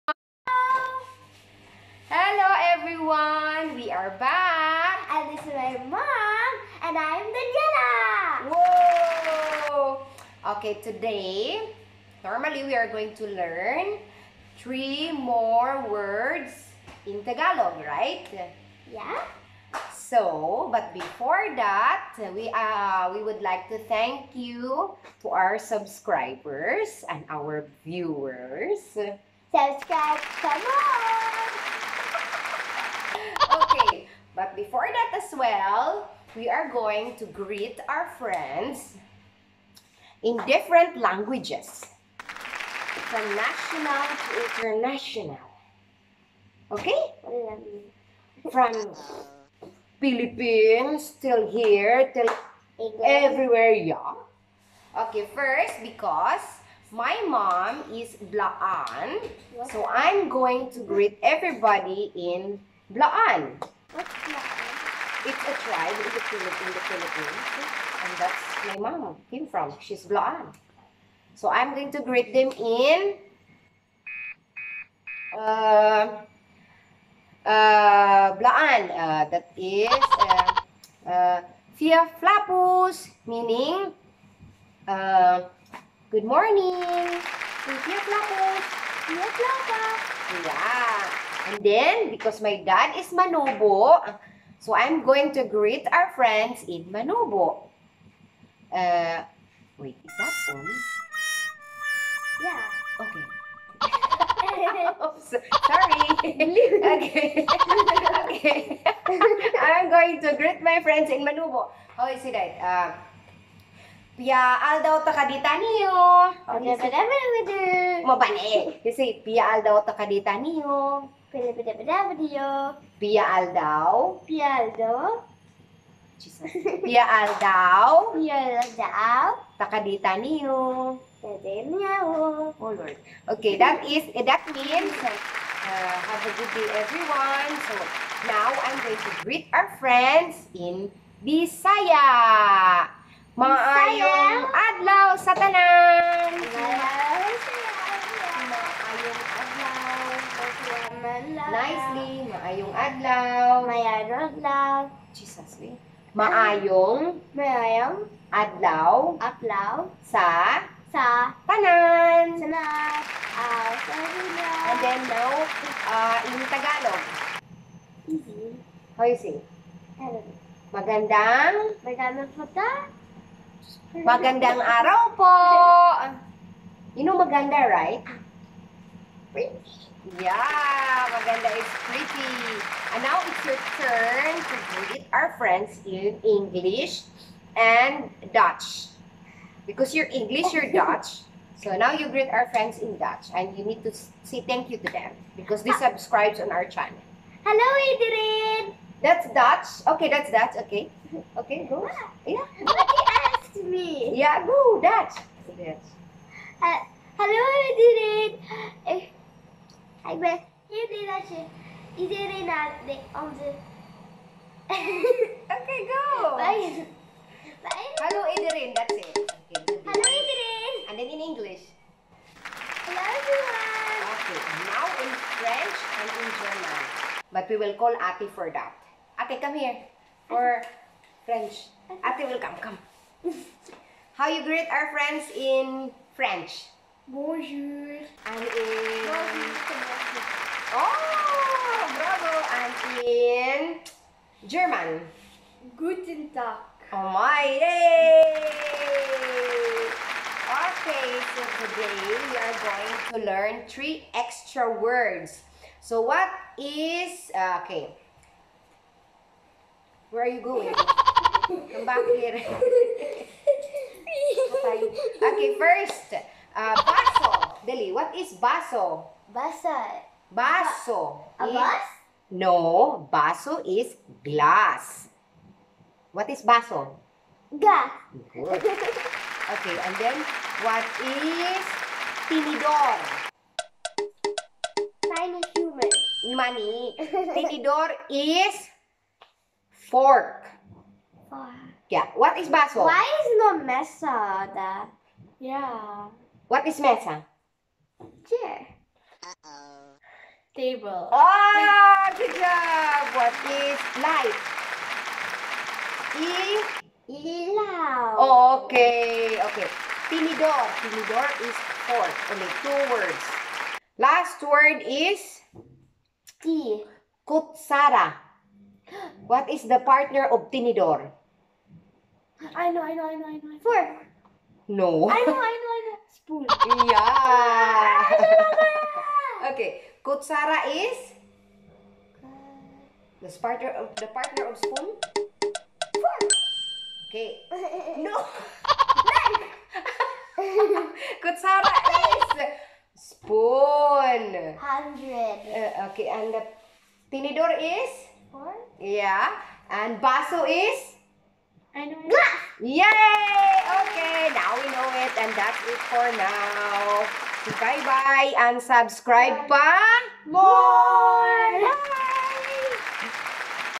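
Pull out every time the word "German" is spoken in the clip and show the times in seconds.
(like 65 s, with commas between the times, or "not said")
226 s, 244 s.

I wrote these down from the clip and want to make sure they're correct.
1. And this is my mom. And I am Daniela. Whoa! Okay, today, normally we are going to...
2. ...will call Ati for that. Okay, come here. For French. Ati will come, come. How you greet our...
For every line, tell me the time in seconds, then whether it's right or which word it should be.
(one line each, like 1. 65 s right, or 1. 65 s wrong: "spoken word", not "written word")
1. 5 s right
2. 227 s right.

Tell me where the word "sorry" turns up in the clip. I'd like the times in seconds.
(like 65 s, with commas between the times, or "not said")
105 s, 163 s.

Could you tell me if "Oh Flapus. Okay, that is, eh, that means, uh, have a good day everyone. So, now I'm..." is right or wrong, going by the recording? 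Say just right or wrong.
wrong.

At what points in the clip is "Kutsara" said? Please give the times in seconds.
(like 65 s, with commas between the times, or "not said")
317 s, 330 s, 341 s.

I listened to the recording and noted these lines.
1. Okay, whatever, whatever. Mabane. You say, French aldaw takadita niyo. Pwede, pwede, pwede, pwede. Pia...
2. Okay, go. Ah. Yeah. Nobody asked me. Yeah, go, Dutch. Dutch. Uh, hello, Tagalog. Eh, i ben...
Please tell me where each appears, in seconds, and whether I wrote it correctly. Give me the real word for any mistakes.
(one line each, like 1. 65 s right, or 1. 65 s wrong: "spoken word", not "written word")
1. 116 s wrong: "Pia", not "French"
2. 201 s wrong: "Adrian", not "Tagalog".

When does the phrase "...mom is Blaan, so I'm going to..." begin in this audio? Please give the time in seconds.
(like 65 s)
57 s.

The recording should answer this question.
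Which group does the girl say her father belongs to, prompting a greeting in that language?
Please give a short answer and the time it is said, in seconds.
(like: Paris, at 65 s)
Manobo, at 93 s.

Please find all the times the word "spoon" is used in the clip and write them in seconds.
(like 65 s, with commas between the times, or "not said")
326 s, 334 s, 342 s.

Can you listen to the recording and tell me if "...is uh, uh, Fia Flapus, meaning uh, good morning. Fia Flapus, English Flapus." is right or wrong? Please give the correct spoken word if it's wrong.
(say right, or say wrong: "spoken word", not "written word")
wrong: "Fia", not "English".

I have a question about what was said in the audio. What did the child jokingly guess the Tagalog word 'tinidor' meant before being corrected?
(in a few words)
tiny human.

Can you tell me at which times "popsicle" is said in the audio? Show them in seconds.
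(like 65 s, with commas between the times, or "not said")
not said.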